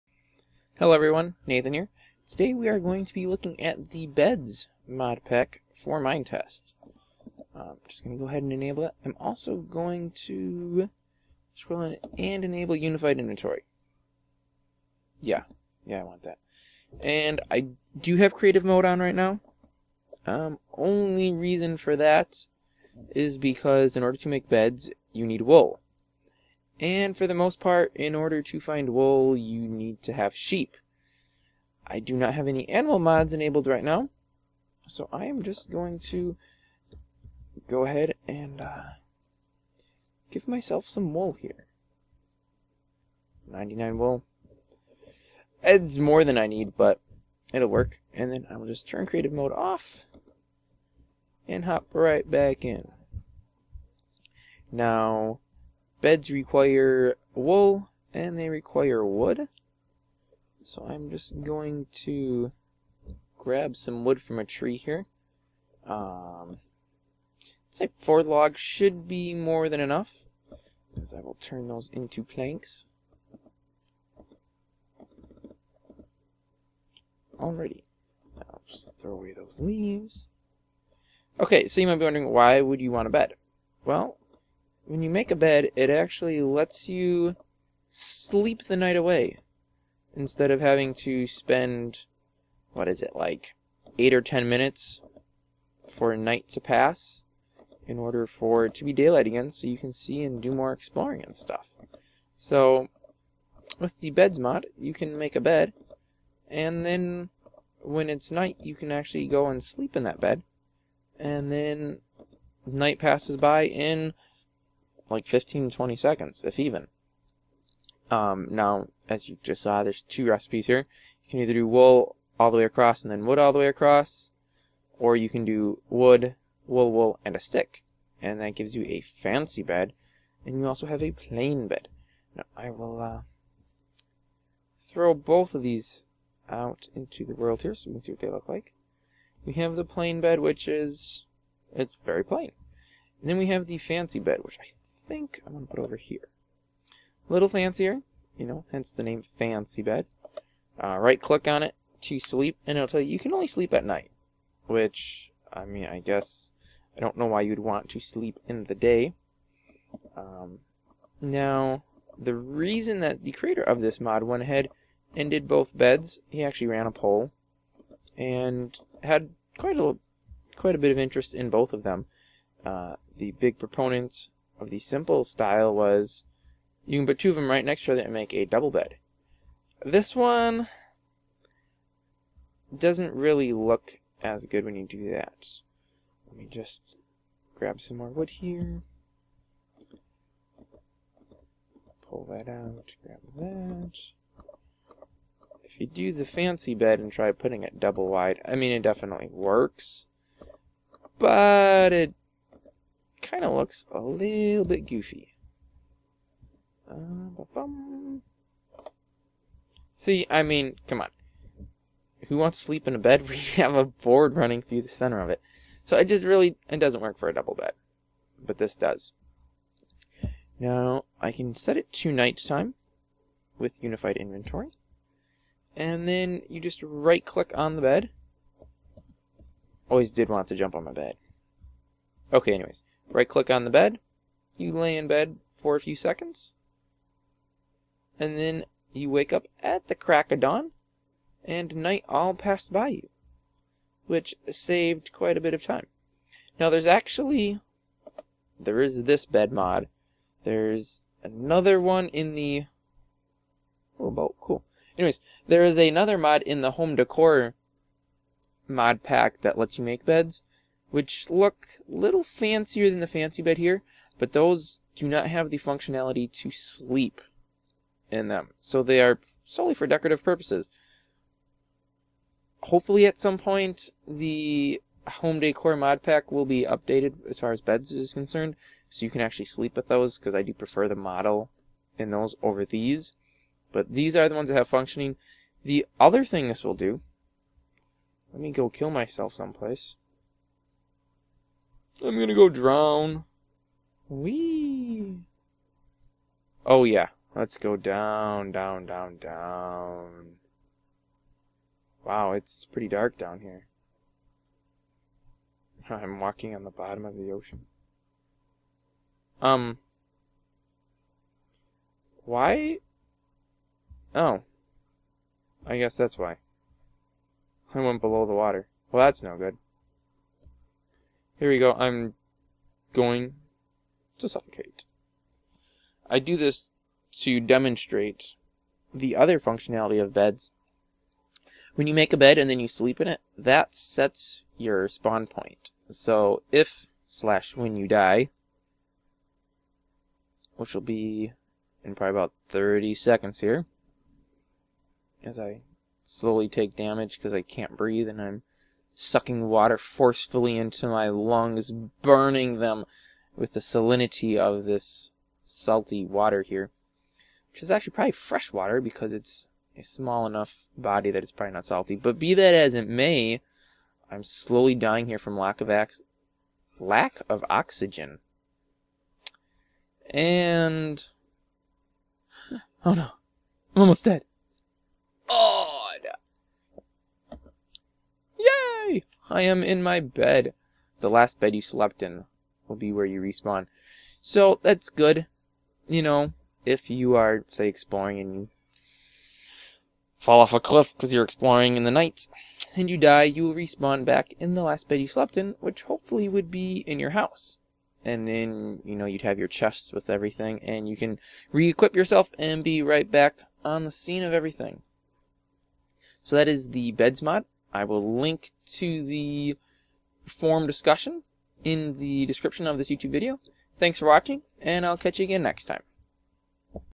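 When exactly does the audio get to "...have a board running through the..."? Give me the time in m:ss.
3:33.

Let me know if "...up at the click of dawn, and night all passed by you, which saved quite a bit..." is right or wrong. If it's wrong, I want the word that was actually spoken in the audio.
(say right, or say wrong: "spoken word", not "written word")
wrong: "crack", not "click".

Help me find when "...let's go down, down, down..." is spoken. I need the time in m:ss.
4:57.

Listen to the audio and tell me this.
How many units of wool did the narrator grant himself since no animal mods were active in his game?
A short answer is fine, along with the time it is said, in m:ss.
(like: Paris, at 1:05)
99, at 0:43.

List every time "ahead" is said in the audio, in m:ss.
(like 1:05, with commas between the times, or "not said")
0:08, 0:37, 2:44.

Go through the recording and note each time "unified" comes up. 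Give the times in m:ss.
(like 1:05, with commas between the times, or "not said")
0:12, 3:43.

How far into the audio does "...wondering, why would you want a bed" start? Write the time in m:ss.
1:22.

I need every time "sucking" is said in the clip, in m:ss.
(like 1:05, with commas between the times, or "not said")
5:48.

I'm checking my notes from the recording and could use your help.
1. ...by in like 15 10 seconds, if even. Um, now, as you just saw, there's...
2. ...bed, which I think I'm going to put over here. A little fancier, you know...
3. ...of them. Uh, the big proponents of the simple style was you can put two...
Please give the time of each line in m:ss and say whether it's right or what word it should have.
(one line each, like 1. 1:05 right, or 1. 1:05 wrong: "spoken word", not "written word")
1. 1:53 wrong: "20", not "10"
2. 2:24 right
3. 2:51 right.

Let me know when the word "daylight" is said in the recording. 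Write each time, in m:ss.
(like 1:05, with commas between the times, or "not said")
1:38.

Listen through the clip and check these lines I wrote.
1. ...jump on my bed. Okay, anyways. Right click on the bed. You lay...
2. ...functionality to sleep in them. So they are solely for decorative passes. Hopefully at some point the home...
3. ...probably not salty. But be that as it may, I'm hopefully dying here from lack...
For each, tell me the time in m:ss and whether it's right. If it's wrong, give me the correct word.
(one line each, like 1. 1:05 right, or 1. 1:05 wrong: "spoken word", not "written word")
1. 3:50 right
2. 4:25 wrong: "purposes", not "passes"
3. 6:01 wrong: "slowly", not "hopefully".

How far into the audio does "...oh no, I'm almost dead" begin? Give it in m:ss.
6:12.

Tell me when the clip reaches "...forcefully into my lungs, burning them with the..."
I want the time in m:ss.
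5:49.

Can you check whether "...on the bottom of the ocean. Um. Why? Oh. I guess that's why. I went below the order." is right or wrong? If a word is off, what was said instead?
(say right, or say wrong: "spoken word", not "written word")
wrong: "water", not "order".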